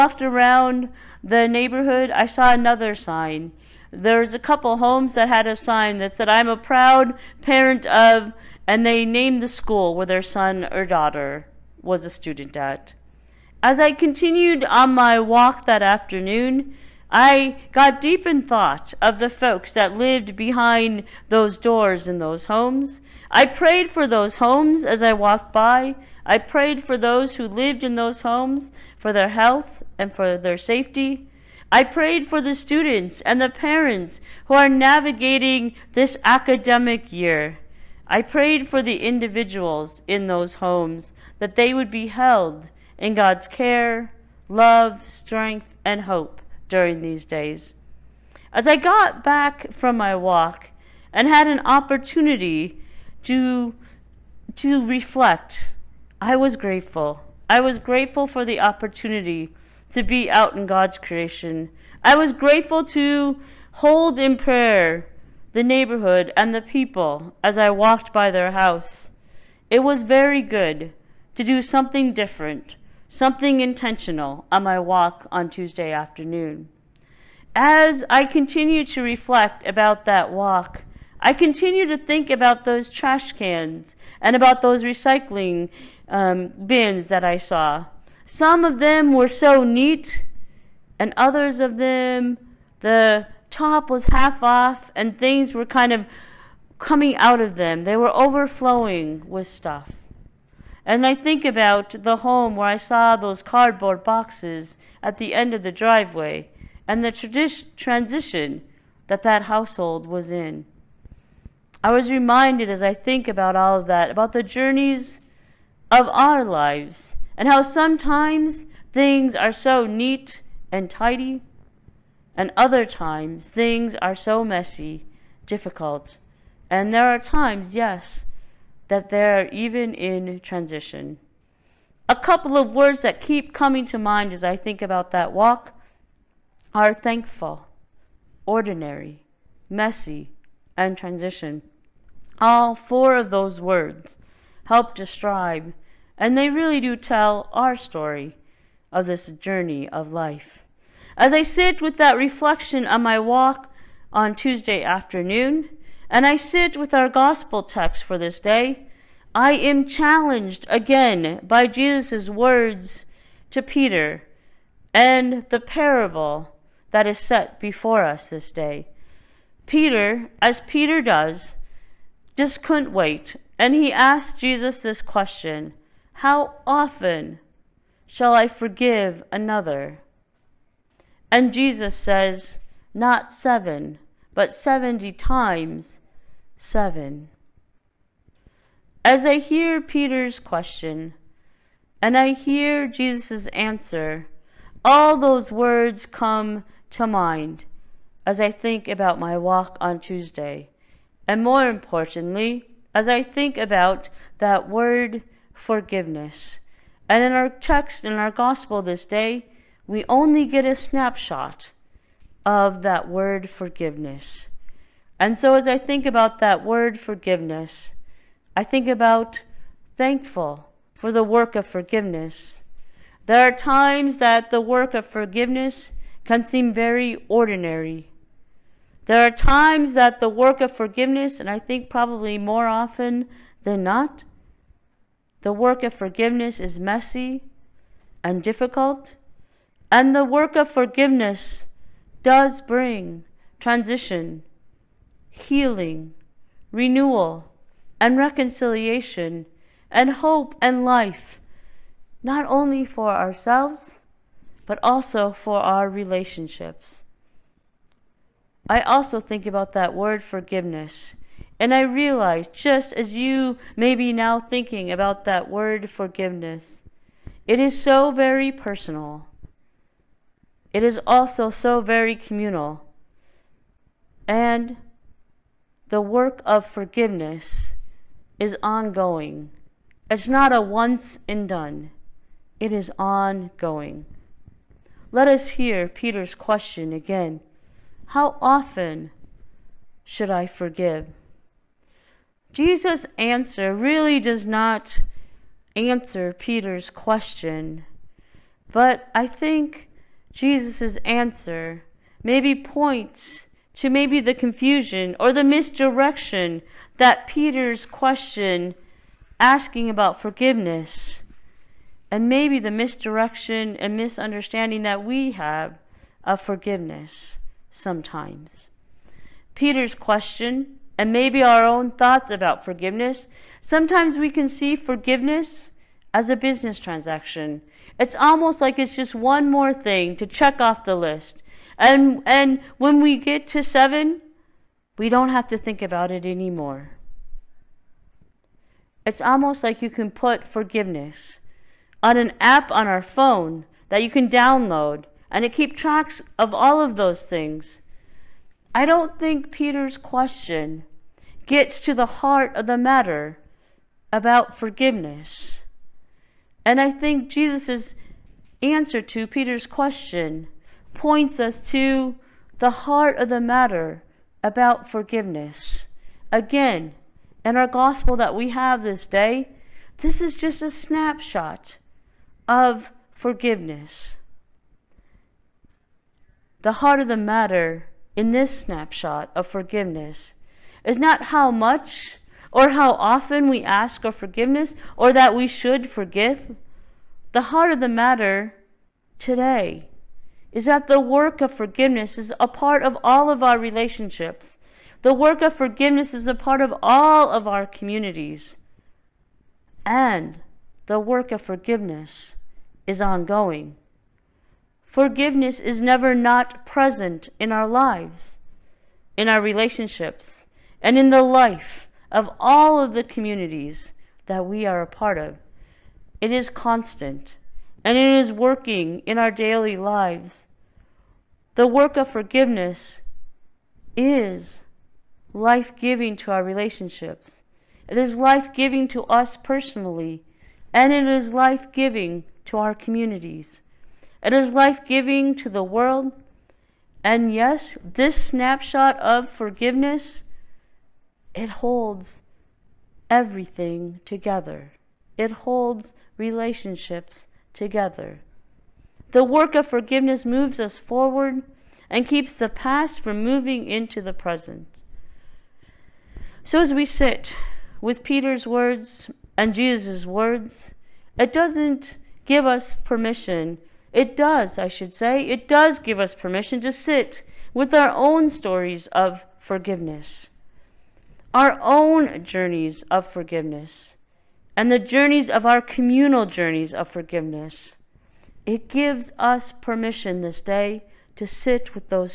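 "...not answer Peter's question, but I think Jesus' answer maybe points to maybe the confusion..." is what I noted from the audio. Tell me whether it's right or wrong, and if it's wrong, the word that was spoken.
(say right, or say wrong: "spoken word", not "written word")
right.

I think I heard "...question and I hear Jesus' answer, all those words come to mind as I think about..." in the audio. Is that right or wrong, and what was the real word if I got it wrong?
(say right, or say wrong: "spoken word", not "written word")
right.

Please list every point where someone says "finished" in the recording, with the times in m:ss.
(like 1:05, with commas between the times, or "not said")
not said.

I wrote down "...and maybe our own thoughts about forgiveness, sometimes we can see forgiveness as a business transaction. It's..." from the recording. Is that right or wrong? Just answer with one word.
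right.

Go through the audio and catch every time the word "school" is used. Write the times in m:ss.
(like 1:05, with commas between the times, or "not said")
0:09.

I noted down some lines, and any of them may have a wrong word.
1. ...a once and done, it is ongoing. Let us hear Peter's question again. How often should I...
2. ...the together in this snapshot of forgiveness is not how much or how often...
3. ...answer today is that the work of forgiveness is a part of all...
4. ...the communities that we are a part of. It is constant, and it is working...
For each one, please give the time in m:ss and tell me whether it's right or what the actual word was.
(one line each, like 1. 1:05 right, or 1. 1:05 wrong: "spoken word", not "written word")
1. 4:40 right
2. 6:17 wrong: "matter", not "together"
3. 6:27 wrong: "matter", not "answer"
4. 6:52 right.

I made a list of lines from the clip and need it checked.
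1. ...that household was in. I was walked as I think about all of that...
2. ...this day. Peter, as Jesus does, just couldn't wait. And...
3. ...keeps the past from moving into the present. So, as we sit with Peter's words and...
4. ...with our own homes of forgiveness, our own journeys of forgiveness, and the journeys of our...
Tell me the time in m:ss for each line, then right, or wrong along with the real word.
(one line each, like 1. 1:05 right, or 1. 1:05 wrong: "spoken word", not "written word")
1. 1:49 wrong: "reminded", not "walked"
2. 2:48 wrong: "Peter", not "Jesus"
3. 7:32 right
4. 7:47 wrong: "stories", not "homes".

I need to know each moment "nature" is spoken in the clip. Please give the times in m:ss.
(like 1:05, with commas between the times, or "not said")
not said.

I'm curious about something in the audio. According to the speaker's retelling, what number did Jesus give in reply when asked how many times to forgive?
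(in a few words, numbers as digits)
70 times seven.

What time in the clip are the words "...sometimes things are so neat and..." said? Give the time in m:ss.
1:57.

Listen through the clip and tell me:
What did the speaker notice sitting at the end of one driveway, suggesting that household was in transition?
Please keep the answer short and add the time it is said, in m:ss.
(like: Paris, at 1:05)
Cardboard boxes, at 1:43.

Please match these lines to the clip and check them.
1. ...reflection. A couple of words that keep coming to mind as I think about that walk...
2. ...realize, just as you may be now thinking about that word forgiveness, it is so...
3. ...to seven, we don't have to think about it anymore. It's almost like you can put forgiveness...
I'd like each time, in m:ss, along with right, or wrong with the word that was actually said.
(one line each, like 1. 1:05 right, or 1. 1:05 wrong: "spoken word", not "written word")
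1. 2:10 wrong: "transition", not "reflection"
2. 4:21 right
3. 5:33 right.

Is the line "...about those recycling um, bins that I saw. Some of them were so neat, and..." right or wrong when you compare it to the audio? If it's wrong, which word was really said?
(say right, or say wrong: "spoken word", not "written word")
right.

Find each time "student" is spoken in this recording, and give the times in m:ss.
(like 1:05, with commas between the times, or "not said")
0:12, 0:32.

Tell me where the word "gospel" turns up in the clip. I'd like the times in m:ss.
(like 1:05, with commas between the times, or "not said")
2:37, 3:28, 6:07.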